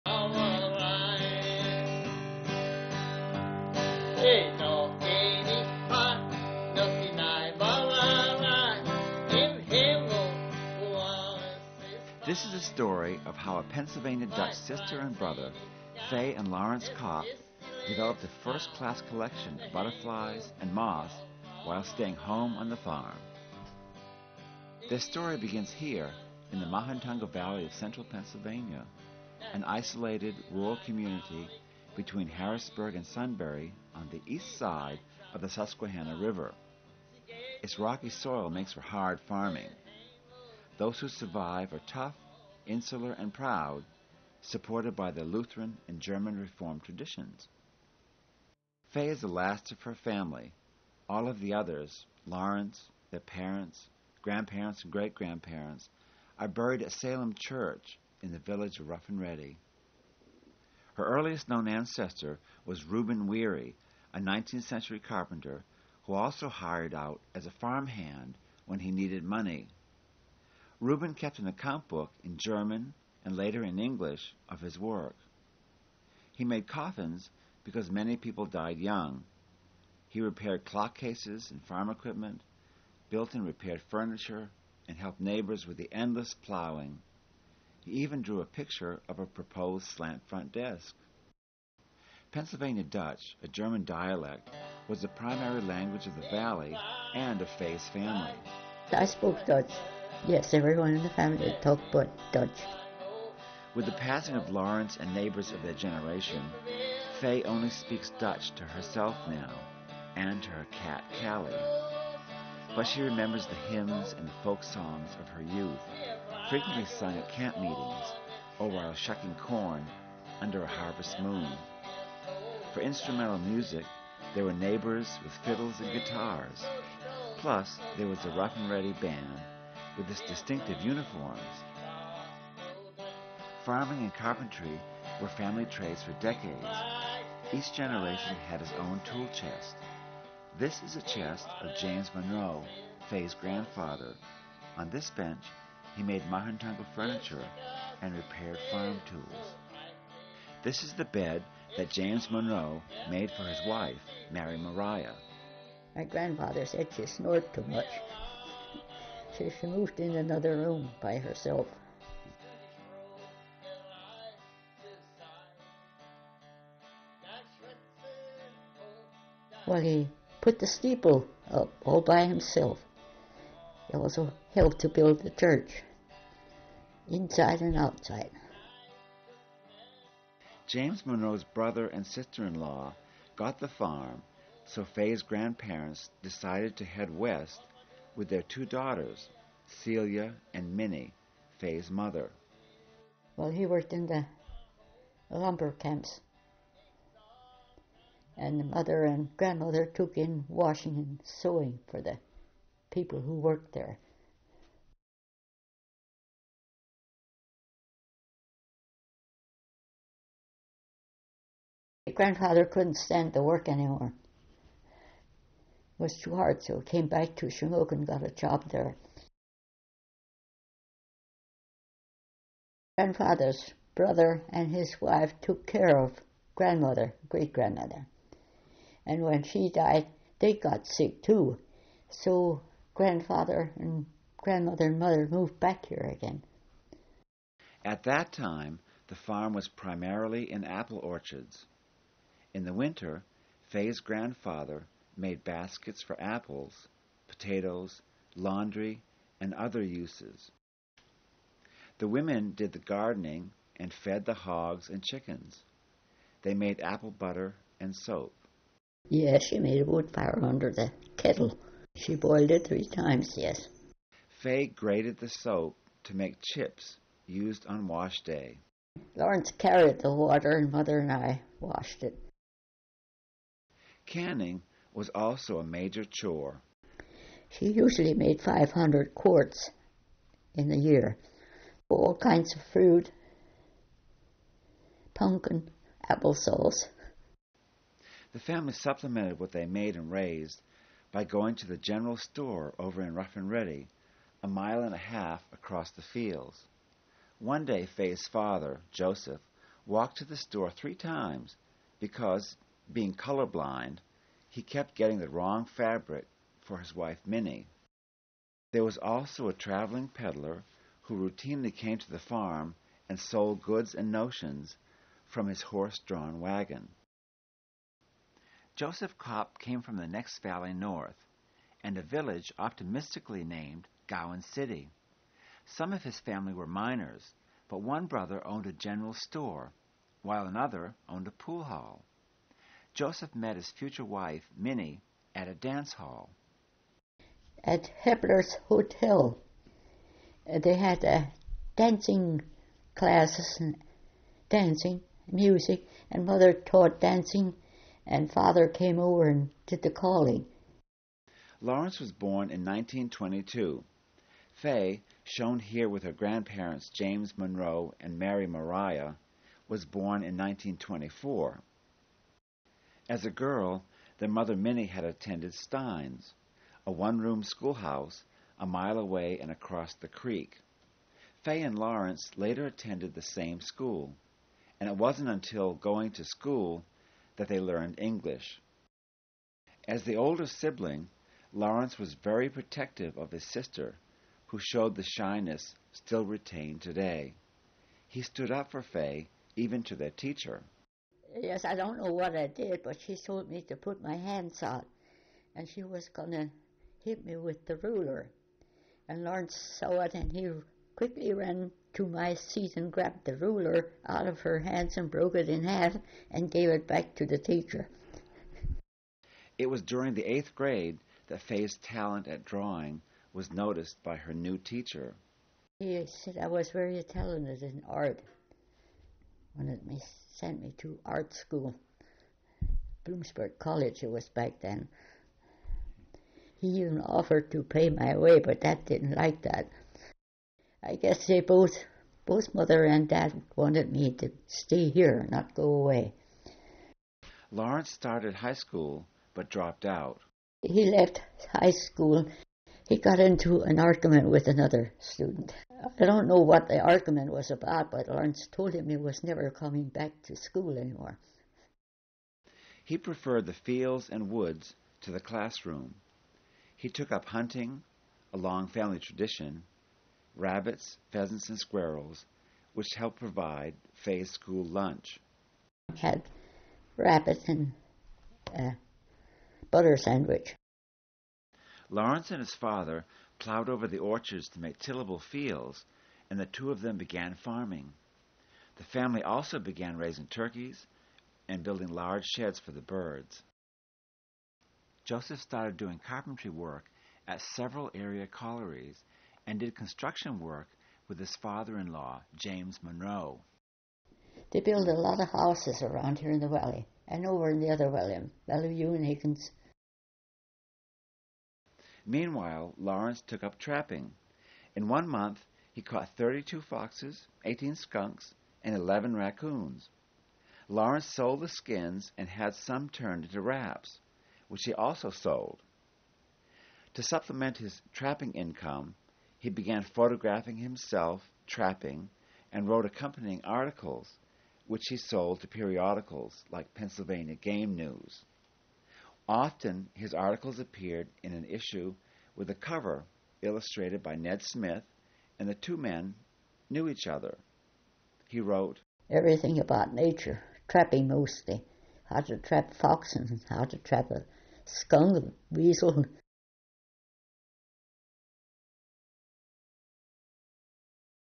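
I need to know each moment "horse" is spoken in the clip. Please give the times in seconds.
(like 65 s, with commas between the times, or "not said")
315 s.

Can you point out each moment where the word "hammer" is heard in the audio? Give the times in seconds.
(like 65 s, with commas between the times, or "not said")
not said.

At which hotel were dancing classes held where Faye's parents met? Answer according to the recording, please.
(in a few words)
Hepler's Hotel.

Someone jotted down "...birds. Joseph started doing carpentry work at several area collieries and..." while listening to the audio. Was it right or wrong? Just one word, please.
right.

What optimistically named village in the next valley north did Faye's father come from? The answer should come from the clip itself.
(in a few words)
Gowen City.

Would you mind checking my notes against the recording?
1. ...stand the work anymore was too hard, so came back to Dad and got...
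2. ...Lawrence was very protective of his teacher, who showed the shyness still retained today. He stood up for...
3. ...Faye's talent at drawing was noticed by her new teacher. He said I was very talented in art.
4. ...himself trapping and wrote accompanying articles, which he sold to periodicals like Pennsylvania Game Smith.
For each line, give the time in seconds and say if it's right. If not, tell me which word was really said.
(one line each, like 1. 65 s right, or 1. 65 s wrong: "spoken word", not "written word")
1. 212 s wrong: "Shingok", not "Dad"
2. 381 s wrong: "sister", not "teacher"
3. 411 s right
4. 520 s wrong: "News", not "Smith".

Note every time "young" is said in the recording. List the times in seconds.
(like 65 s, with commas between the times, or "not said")
78 s.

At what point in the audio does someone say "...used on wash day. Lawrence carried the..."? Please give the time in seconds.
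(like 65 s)
267 s.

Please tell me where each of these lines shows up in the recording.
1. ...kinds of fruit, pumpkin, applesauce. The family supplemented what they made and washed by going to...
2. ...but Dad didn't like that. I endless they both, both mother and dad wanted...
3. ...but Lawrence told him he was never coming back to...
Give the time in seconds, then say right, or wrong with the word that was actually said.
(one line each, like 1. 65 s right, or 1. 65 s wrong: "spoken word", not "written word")
1. 282 s wrong: "raised", not "washed"
2. 428 s wrong: "guess", not "endless"
3. 447 s right.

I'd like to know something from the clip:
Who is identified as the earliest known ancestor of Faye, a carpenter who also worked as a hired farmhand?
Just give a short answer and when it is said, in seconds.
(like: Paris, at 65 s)
Reuben Weary, at 62 s.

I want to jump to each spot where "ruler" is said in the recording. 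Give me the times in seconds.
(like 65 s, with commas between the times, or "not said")
397 s, 403 s.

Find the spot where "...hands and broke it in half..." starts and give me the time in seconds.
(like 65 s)
404 s.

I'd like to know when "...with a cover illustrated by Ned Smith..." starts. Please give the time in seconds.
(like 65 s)
532 s.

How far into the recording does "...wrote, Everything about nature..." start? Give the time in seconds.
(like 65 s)
538 s.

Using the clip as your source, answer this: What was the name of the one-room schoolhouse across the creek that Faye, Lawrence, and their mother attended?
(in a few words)
Stein's.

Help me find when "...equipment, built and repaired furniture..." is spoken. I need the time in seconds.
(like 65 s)
81 s.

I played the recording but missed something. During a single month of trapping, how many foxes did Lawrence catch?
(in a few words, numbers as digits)
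32.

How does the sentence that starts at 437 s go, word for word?
Lawrence started high school, but dropped out.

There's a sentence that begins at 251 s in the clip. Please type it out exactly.
The women did the gardening and fed the hogs and chickens.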